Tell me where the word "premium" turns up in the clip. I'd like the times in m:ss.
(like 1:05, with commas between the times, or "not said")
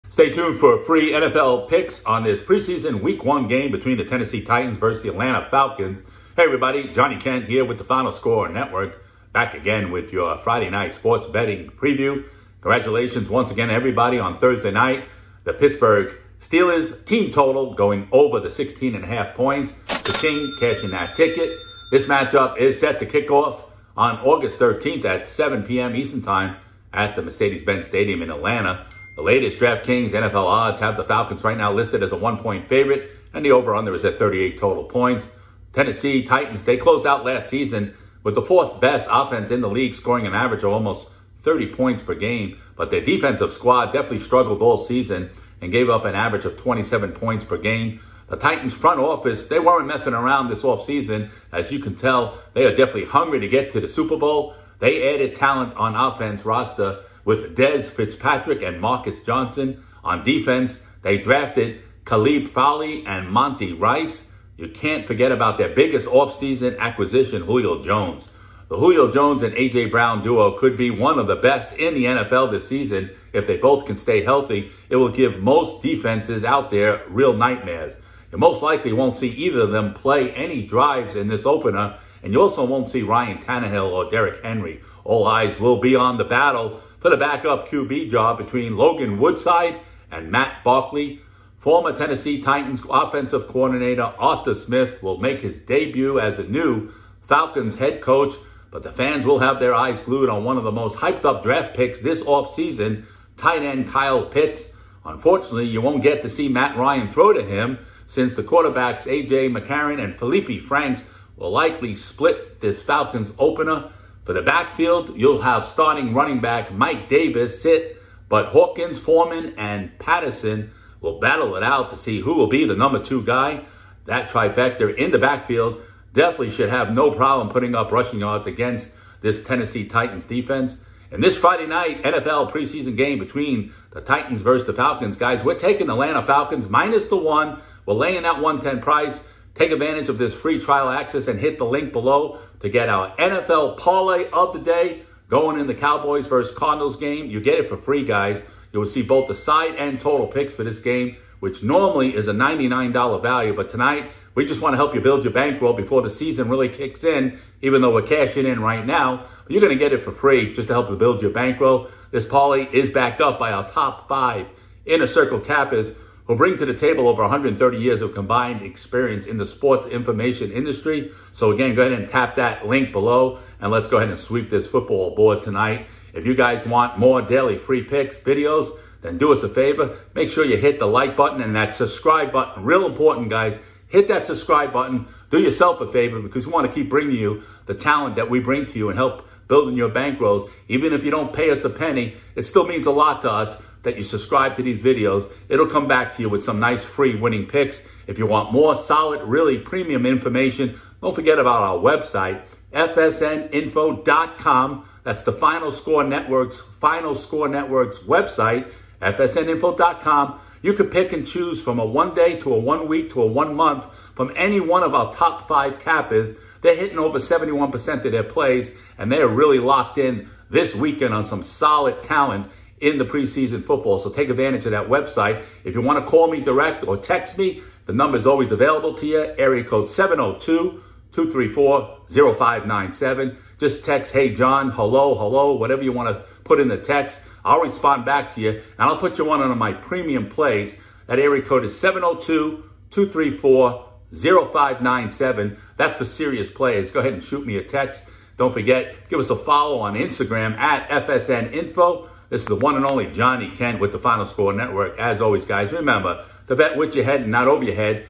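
3:19, 3:59.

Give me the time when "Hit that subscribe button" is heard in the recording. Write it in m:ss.
3:03.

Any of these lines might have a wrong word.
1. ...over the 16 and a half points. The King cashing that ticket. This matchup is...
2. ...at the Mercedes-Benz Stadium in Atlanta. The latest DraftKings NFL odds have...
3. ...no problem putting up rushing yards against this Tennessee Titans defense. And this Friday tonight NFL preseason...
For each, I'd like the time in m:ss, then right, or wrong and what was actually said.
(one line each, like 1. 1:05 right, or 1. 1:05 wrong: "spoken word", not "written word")
1. 0:18 right
2. 0:26 right
3. 2:06 wrong: "night", not "tonight".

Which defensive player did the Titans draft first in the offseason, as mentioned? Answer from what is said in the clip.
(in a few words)
Caleb Farley.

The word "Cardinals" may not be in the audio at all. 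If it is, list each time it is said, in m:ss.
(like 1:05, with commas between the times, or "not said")
2:26.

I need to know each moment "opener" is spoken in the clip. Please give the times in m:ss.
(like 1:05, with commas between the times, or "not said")
1:21, 1:53.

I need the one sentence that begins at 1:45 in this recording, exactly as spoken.
Unfortunately, you won't get to see Matt Ryan throw to him since the quarterbacks A.J.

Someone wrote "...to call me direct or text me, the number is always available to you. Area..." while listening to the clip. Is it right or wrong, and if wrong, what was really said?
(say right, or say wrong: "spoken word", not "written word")
right.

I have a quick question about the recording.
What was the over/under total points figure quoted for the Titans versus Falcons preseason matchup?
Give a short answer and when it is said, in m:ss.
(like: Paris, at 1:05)
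38, at 0:34.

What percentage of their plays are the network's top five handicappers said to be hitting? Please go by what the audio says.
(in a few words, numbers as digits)
over 71%.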